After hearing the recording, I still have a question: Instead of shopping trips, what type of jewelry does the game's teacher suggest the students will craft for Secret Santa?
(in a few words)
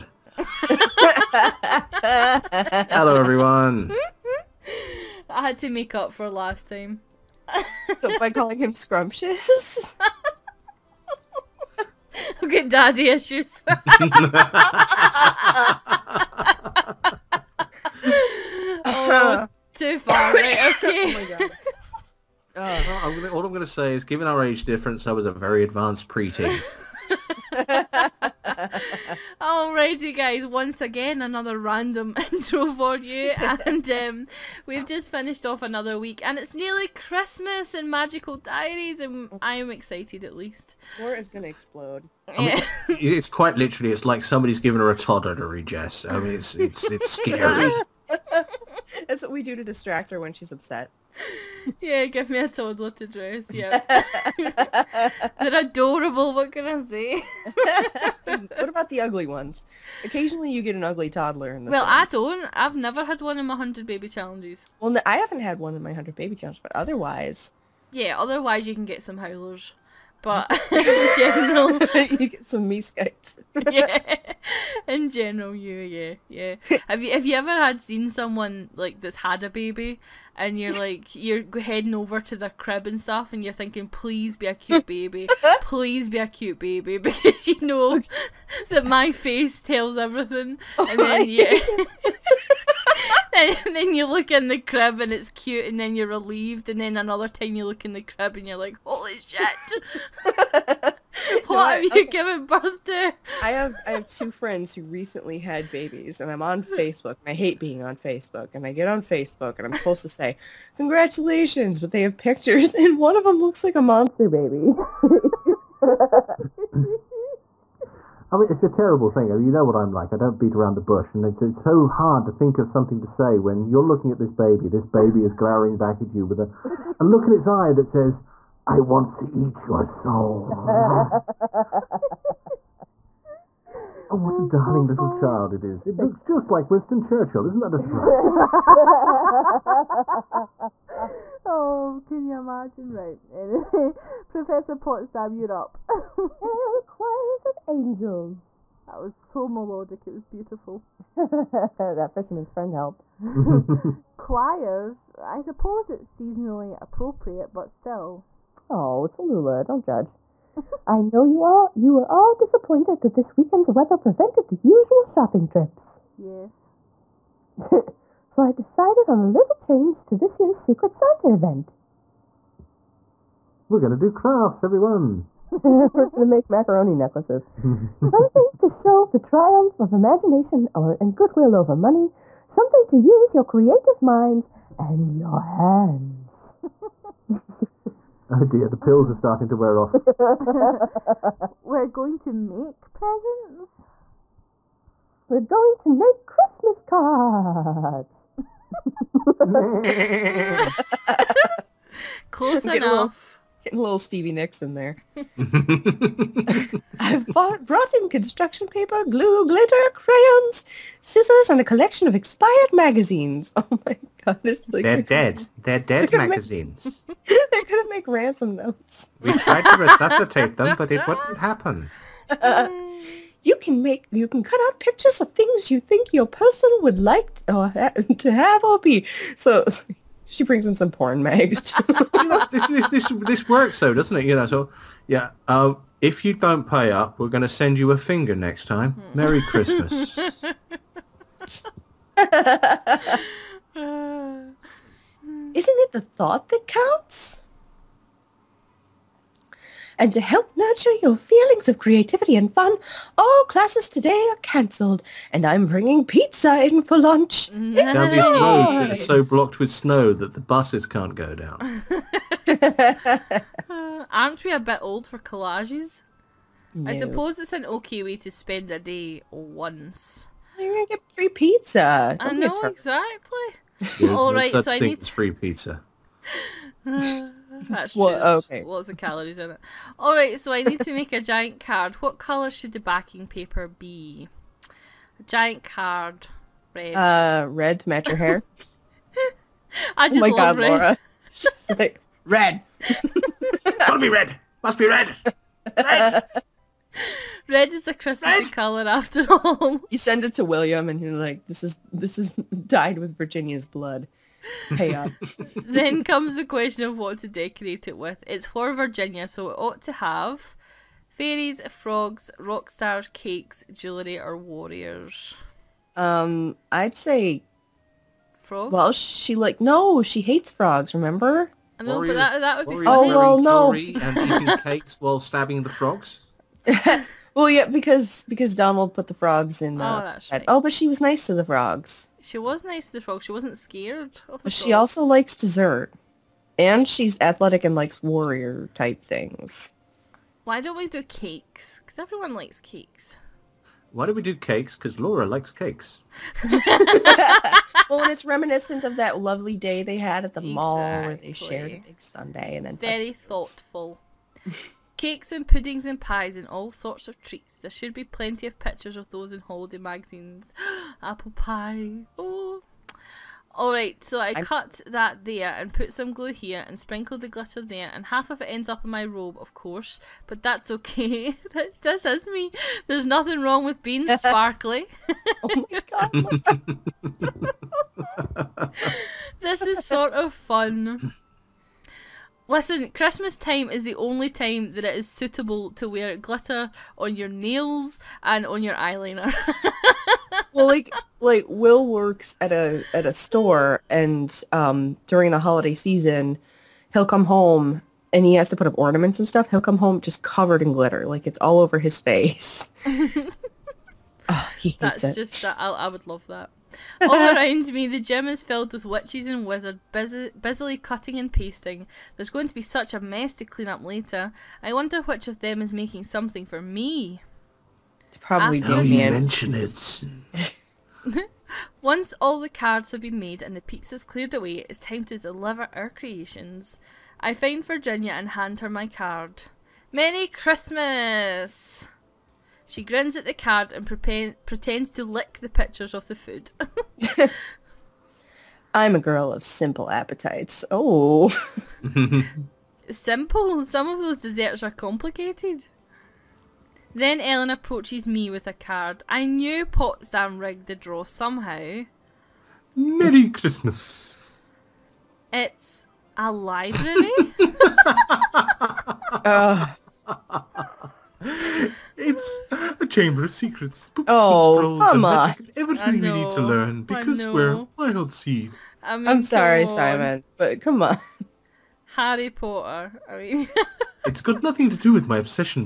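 macaroni necklaces.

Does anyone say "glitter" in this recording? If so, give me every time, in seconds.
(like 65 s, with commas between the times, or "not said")
209 s, 367 s, 386 s, 400 s.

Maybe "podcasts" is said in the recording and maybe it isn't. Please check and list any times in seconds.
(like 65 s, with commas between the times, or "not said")
not said.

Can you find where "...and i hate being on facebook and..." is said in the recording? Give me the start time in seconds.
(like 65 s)
107 s.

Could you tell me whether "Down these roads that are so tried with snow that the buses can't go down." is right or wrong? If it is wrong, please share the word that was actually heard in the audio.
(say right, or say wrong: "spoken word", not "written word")
wrong: "blocked", not "tried".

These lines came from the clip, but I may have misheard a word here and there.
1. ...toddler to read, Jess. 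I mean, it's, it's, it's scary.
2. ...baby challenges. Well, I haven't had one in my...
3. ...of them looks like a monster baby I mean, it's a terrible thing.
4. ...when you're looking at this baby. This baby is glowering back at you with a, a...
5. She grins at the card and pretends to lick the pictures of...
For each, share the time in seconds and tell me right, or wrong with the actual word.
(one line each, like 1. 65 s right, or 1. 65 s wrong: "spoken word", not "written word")
1. 44 s right
2. 63 s right
3. 113 s right
4. 123 s right
5. 432 s right.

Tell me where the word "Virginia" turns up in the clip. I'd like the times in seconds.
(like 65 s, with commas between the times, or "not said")
303 s, 308 s, 427 s.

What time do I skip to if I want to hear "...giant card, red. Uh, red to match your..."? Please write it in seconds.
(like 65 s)
285 s.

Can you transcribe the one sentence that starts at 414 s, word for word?
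I wonder which of them is making something for me.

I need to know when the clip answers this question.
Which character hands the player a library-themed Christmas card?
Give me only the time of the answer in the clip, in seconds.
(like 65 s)
447 s.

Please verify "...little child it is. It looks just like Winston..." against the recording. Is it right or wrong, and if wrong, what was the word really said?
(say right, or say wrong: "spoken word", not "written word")
right.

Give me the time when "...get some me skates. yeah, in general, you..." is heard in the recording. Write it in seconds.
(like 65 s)
72 s.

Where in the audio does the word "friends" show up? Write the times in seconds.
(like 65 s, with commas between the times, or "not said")
104 s, 152 s.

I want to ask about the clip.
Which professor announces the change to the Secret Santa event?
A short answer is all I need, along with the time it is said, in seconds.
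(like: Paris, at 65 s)
Professor Potsdam, at 144 s.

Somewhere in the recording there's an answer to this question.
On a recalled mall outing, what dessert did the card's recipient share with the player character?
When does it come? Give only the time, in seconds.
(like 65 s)
351 s.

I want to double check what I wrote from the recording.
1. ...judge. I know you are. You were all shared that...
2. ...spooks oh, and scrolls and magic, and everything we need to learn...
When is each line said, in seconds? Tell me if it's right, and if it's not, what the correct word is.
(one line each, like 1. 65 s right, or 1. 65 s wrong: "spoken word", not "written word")
1. 159 s wrong: "disappointed", not "shared"
2. 463 s right.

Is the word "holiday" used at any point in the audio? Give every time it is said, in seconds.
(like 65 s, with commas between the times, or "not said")
359 s, 395 s.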